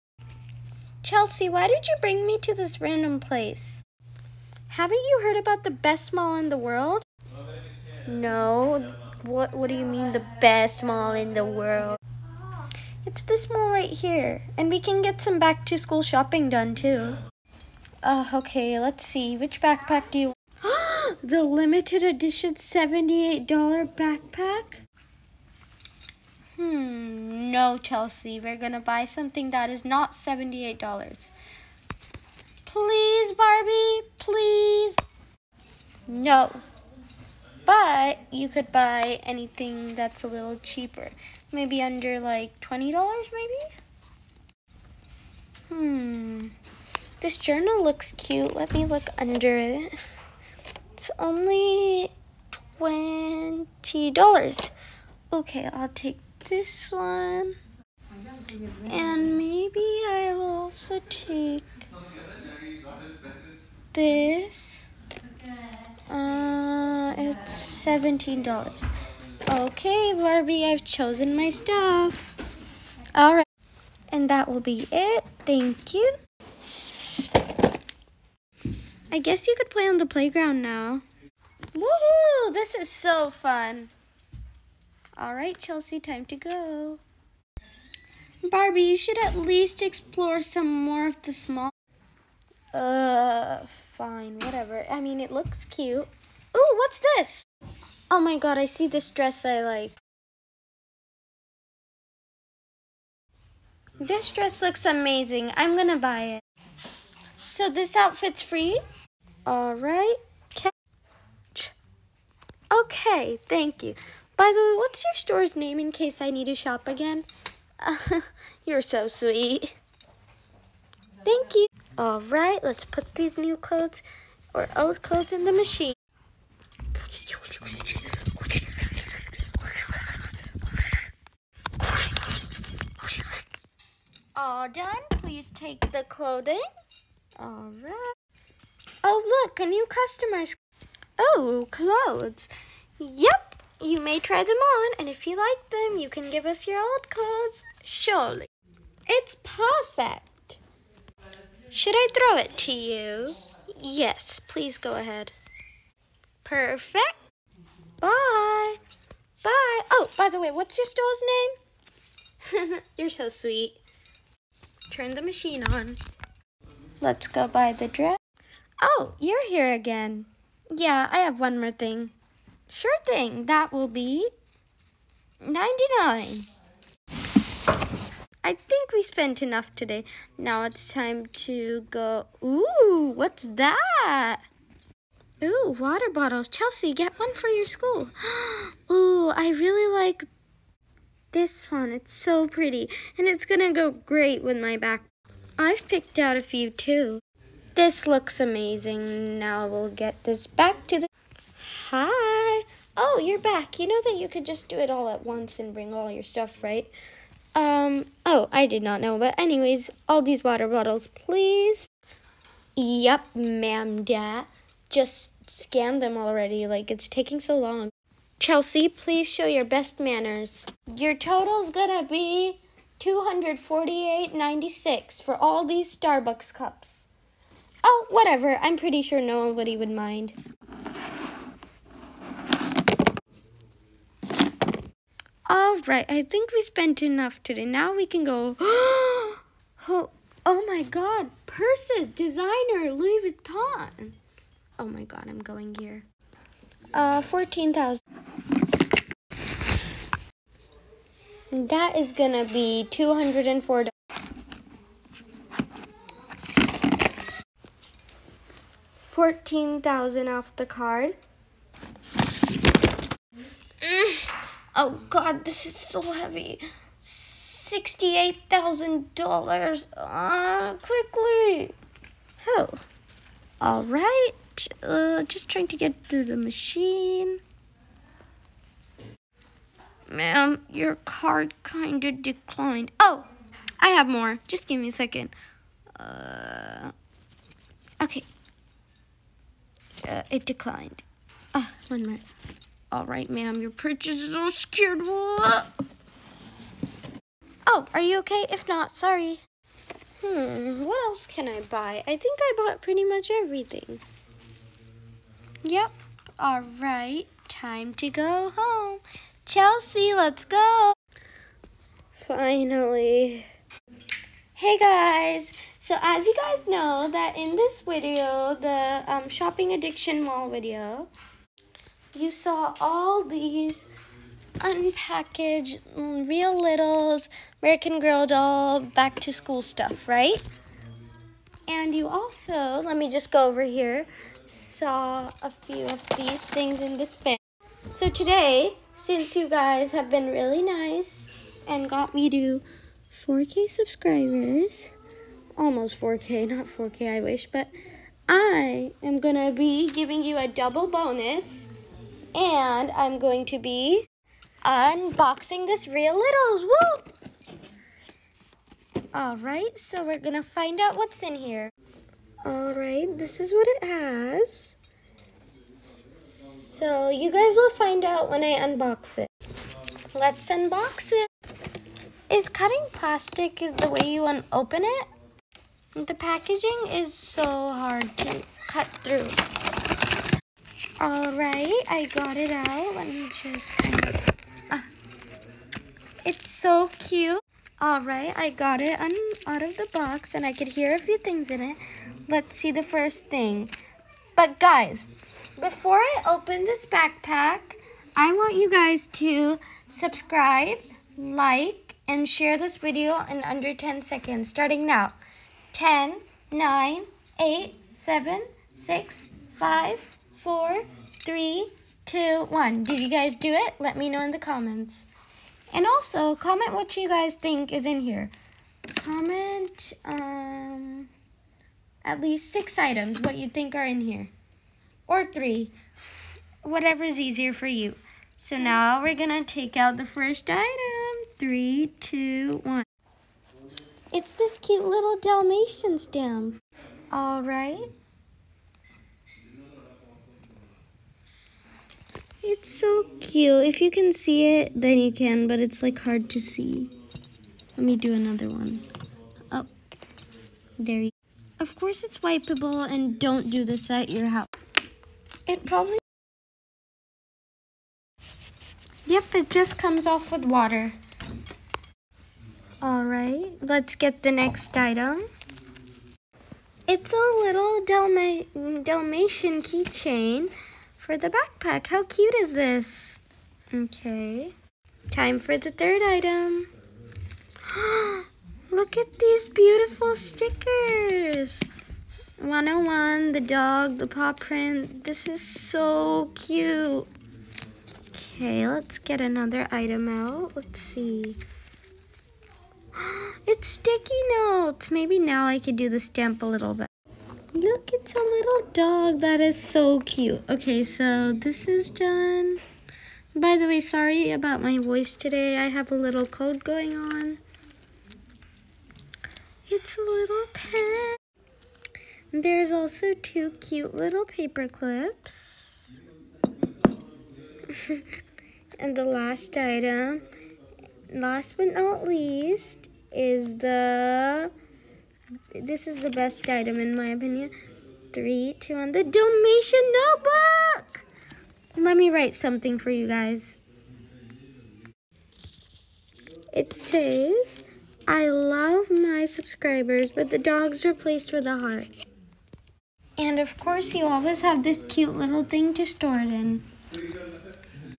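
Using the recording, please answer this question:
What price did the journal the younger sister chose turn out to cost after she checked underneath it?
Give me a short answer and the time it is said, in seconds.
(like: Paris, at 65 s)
$20, at 50 s.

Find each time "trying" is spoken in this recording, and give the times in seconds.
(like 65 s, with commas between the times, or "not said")
275 s.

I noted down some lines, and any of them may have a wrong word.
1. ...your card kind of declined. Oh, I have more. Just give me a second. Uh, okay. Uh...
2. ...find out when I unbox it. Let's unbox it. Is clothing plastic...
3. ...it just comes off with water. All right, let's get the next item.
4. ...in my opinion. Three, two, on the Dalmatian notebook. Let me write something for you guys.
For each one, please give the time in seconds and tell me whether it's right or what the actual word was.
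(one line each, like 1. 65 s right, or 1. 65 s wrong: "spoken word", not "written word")
1. 280 s right
2. 367 s wrong: "cutting", not "clothing"
3. 459 s right
4. 526 s right.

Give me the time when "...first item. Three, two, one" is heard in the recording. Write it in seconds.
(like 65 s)
430 s.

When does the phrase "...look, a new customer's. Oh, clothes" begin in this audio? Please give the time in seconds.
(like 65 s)
139 s.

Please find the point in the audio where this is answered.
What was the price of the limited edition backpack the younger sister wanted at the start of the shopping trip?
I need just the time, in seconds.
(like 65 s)
22 s.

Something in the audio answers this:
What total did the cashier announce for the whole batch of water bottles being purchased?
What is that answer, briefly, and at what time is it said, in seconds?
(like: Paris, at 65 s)
248.96, at 223 s.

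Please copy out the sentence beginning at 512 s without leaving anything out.
There's also two cute little paper clips.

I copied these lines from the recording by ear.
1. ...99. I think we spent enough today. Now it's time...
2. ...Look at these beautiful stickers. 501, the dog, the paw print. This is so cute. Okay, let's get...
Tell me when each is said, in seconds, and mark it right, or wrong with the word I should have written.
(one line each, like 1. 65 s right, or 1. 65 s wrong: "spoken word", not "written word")
1. 175 s right
2. 478 s wrong: "101", not "501".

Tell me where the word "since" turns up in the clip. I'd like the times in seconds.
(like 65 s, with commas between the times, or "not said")
338 s.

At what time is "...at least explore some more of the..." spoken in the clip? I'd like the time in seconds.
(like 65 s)
89 s.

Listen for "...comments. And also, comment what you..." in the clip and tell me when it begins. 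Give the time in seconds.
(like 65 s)
414 s.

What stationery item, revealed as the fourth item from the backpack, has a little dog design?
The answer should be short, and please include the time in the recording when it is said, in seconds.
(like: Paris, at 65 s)
Sticky notes, at 493 s.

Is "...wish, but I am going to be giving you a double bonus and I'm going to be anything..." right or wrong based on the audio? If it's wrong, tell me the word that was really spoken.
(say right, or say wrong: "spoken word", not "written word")
wrong: "unboxing", not "anything".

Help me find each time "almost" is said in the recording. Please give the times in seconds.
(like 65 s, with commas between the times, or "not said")
345 s.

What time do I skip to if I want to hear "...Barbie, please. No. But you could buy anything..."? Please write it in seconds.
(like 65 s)
33 s.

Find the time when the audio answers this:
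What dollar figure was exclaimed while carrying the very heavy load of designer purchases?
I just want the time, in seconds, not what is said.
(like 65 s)
266 s.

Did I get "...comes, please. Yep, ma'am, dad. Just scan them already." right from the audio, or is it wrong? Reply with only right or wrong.
wrong.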